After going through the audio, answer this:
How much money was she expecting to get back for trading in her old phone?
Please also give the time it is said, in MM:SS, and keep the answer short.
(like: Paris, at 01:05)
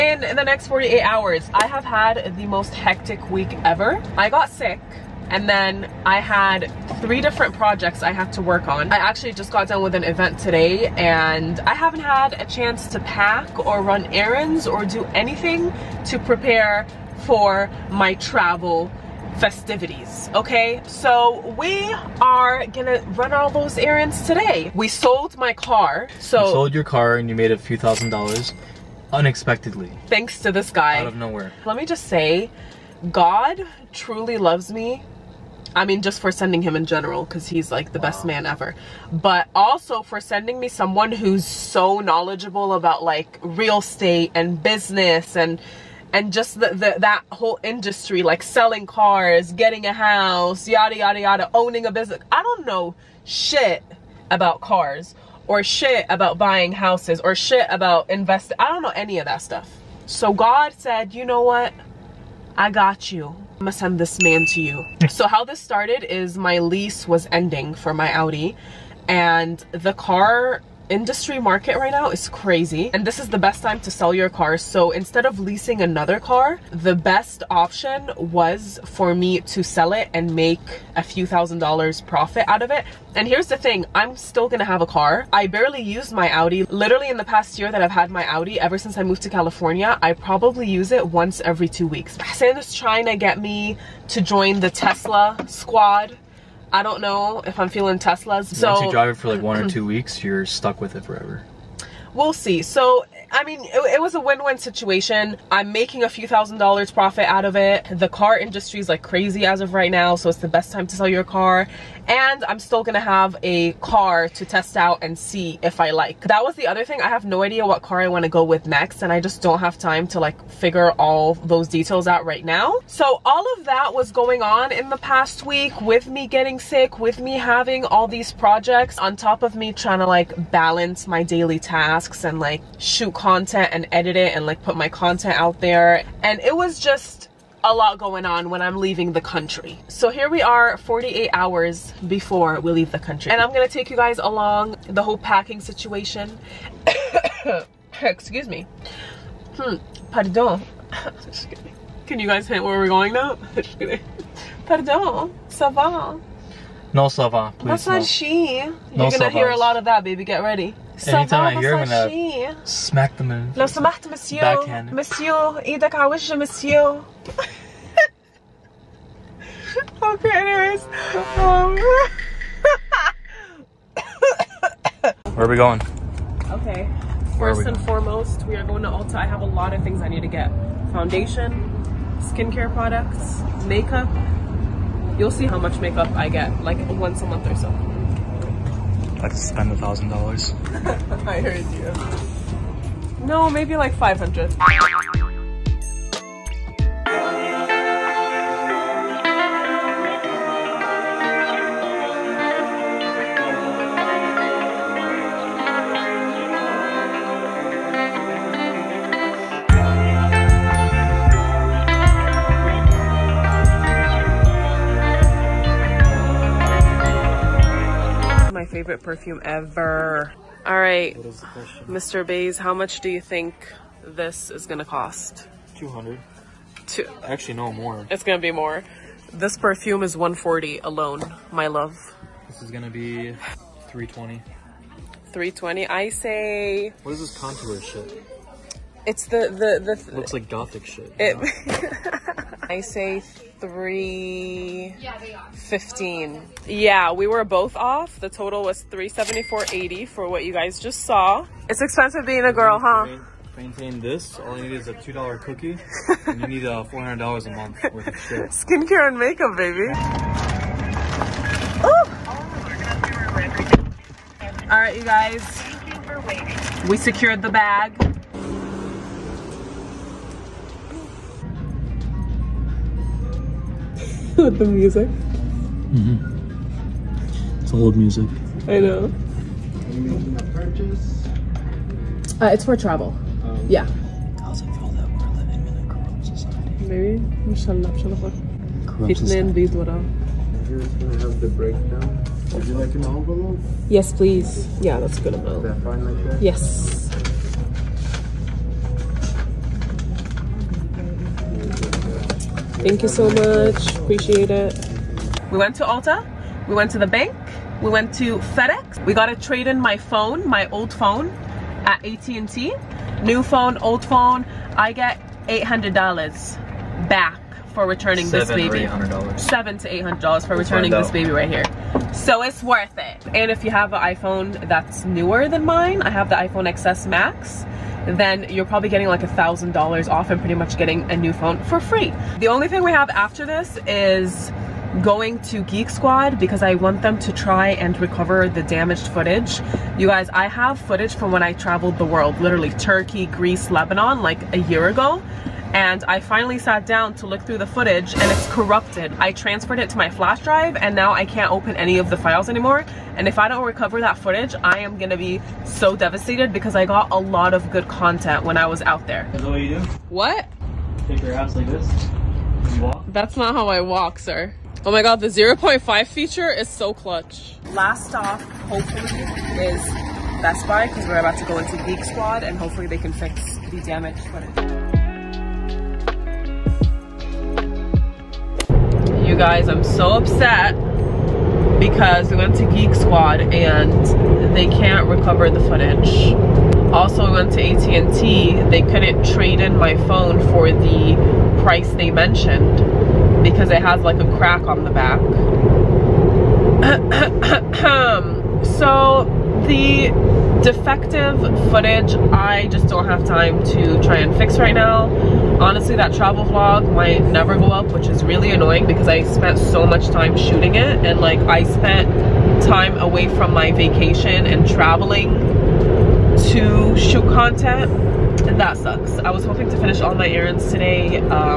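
$800, at 05:14.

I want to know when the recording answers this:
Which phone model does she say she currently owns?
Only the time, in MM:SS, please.
05:26.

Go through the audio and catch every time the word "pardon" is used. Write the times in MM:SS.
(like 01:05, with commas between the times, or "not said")
02:30, 02:34.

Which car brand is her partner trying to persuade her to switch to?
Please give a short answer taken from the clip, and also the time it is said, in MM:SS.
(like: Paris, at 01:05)
Tesla, at 01:32.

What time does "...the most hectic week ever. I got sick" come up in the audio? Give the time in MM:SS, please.
00:02.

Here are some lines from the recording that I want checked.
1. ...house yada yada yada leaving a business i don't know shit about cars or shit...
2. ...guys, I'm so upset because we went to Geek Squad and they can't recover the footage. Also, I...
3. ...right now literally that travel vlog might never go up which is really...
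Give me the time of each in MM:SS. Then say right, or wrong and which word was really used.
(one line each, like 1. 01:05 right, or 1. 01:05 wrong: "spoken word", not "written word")
1. 00:49 wrong: "owning", not "leaving"
2. 06:19 right
3. 06:44 wrong: "honestly", not "literally".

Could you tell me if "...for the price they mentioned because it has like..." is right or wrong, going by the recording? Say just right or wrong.
right.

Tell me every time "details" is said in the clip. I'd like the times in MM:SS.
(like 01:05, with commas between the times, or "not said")
02:01.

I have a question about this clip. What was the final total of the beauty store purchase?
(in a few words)
$374.80.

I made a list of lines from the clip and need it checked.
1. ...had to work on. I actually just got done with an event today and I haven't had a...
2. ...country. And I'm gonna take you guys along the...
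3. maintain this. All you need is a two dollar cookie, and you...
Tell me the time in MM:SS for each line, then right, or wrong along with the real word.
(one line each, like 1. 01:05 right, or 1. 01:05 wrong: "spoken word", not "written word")
1. 00:08 right
2. 02:22 right
3. 04:13 right.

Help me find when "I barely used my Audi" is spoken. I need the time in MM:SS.
01:25.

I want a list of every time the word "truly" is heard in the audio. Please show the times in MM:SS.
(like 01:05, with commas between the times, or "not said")
00:34.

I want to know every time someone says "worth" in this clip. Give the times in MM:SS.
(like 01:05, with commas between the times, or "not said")
04:17, 05:22.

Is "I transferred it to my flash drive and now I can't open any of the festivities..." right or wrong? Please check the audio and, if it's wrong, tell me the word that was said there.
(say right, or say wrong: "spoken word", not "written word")
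wrong: "files", not "festivities".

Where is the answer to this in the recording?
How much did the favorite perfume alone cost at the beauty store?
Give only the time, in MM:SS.
03:49.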